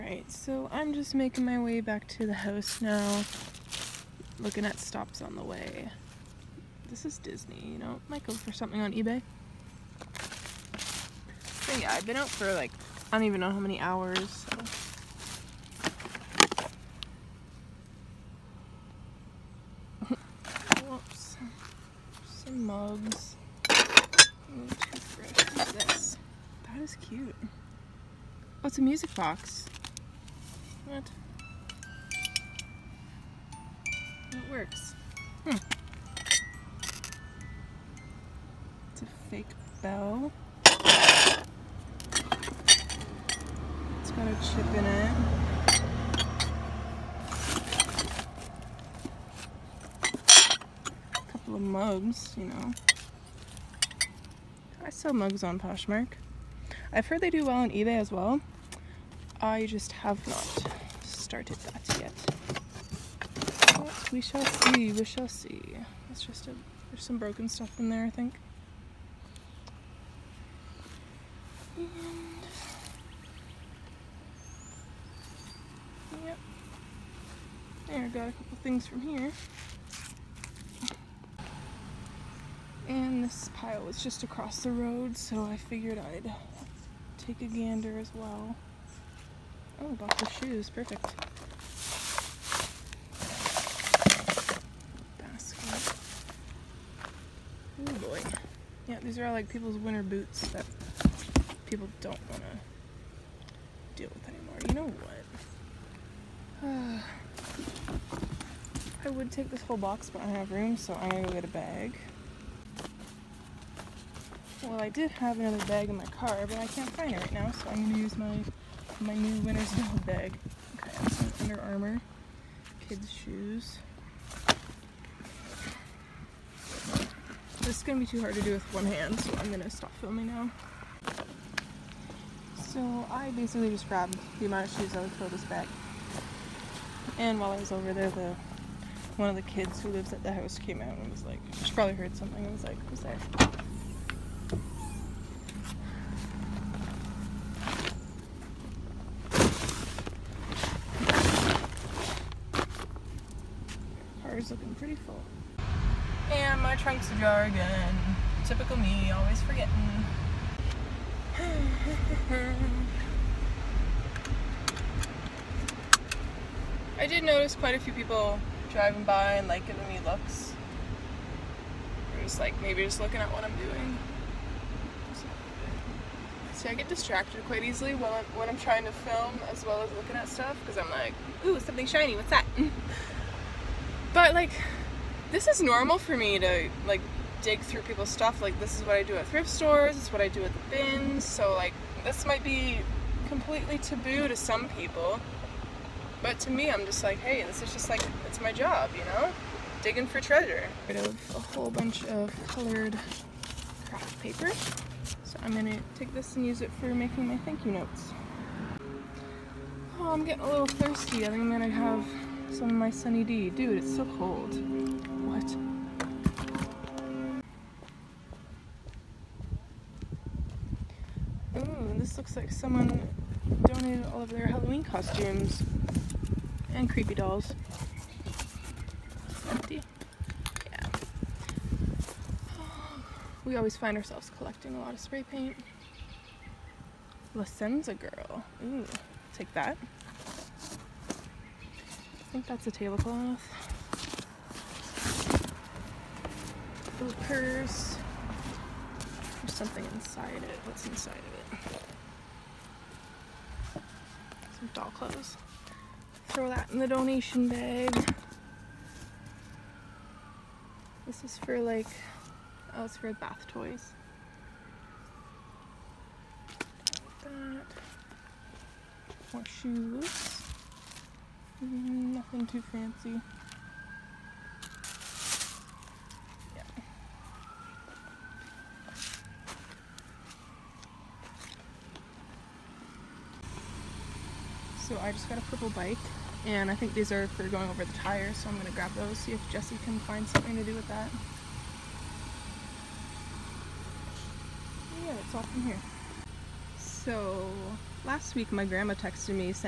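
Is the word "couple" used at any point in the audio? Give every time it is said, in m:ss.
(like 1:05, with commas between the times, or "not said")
0:51, 1:18.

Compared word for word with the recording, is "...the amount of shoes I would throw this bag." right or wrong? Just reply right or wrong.
right.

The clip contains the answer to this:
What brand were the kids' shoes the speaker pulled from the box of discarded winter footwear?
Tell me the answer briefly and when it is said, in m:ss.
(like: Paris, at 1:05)
Under Armour, at 2:01.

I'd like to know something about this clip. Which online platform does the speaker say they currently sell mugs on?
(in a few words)
Poshmark.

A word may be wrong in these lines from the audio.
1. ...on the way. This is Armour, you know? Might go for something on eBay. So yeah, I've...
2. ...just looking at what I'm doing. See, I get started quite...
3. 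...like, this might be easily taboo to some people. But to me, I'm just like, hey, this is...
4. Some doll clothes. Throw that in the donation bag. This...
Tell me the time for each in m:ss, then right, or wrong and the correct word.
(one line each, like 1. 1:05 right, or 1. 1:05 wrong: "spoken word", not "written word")
1. 0:05 wrong: "Disney", not "Armour"
2. 2:52 wrong: "distracted", not "started"
3. 3:11 wrong: "completely", not "easily"
4. 4:14 right.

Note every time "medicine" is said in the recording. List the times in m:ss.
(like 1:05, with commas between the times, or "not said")
not said.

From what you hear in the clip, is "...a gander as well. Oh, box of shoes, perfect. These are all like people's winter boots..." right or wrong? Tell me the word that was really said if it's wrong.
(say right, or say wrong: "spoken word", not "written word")
right.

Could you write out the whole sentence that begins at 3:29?
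Oh, I'm getting a little thirsty.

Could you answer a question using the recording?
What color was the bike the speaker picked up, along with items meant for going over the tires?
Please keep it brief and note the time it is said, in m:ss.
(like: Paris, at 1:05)
Purple, at 4:45.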